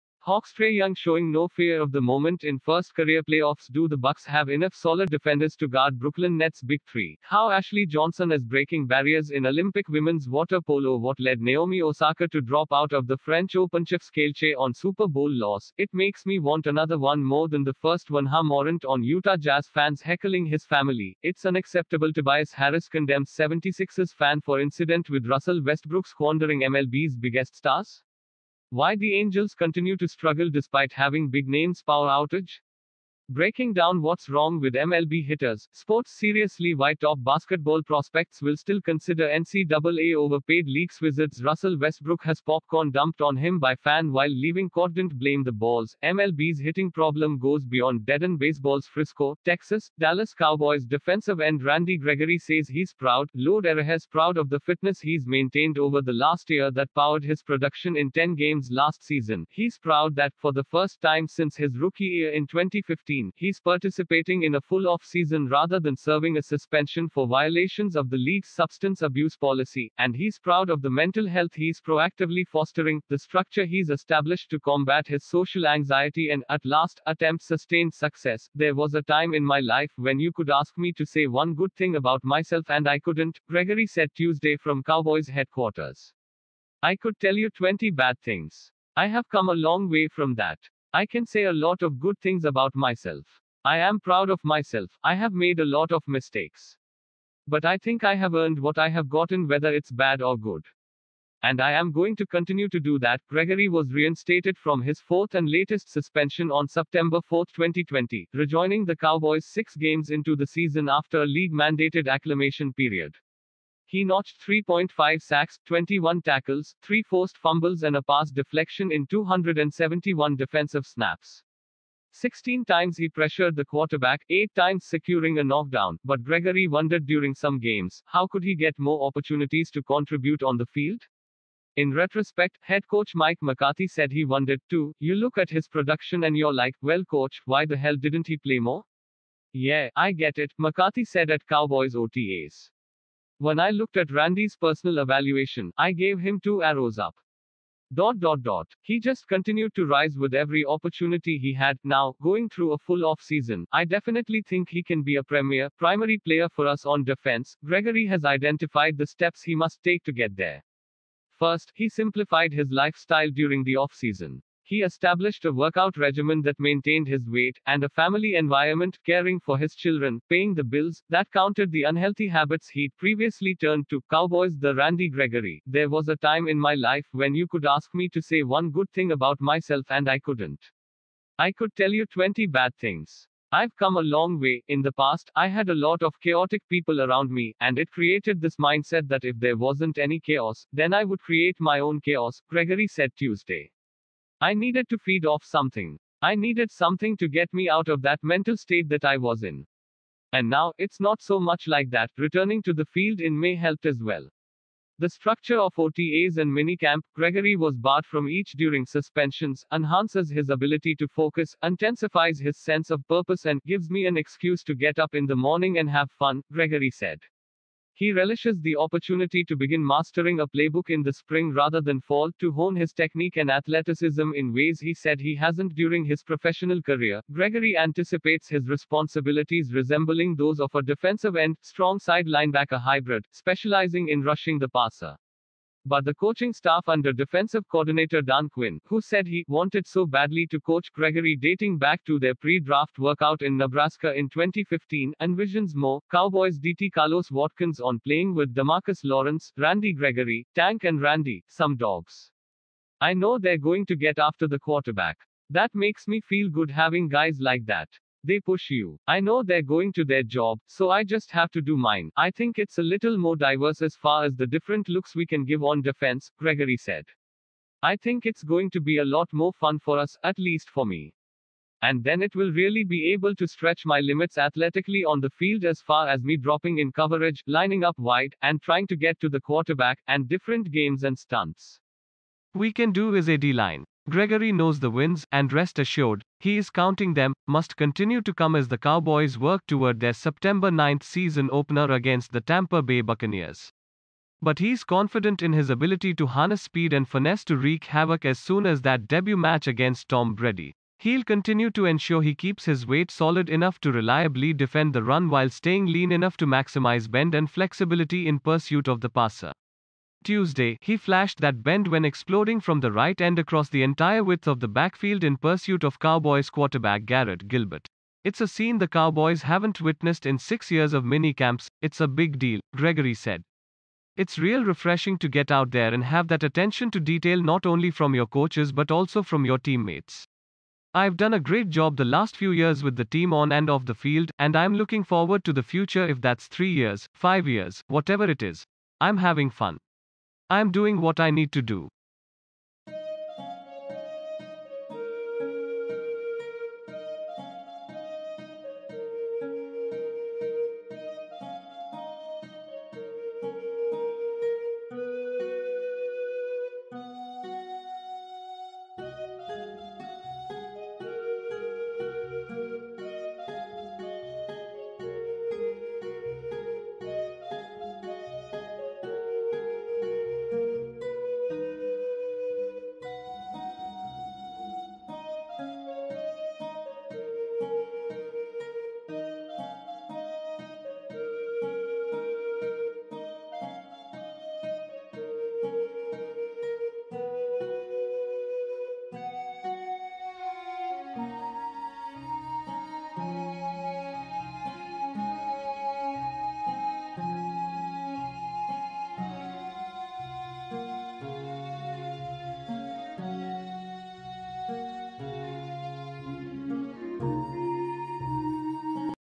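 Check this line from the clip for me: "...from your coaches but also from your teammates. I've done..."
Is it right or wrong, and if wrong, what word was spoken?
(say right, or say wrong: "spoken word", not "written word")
right.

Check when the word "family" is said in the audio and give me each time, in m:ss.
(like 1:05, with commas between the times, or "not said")
0:20, 2:47.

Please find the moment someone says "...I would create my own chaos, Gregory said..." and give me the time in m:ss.
3:10.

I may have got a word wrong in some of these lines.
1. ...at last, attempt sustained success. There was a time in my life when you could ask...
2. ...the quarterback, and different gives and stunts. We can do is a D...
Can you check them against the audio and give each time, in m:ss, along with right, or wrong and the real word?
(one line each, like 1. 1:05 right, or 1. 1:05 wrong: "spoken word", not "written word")
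1. 1:16 right
2. 4:39 wrong: "games", not "gives".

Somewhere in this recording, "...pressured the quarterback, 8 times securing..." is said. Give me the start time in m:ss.
2:03.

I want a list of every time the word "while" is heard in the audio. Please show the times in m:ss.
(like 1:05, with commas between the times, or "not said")
0:44, 5:05.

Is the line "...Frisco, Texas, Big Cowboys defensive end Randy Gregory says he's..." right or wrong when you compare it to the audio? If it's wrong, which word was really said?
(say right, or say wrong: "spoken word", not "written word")
wrong: "Dallas", not "Big".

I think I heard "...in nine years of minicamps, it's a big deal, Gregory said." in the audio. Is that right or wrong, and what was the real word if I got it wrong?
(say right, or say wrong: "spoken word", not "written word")
wrong: "six", not "nine".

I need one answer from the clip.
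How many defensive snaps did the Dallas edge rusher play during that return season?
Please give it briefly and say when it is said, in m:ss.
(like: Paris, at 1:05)
271, at 1:59.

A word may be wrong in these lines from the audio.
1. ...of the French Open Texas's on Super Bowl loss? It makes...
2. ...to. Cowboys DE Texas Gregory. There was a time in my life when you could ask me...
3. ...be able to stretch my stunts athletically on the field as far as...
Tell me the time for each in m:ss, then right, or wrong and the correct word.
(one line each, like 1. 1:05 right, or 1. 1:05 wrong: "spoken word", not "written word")
1. 0:12 wrong: "Chef", not "Texas"
2. 2:53 wrong: "Randy", not "Texas"
3. 4:32 wrong: "limits", not "stunts".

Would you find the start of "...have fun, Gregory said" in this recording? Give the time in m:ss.
3:35.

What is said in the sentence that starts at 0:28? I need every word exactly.
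Why the Angels continue to struggle despite having big names power outage?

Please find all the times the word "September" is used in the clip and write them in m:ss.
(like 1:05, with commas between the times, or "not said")
1:46, 4:50.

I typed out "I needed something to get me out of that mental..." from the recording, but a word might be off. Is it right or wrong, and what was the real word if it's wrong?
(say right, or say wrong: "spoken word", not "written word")
right.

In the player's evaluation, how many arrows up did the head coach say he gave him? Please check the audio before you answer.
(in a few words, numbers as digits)
2.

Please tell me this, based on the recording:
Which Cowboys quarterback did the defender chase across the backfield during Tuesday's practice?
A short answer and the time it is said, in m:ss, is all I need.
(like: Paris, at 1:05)
Garrett Gilbert, at 5:17.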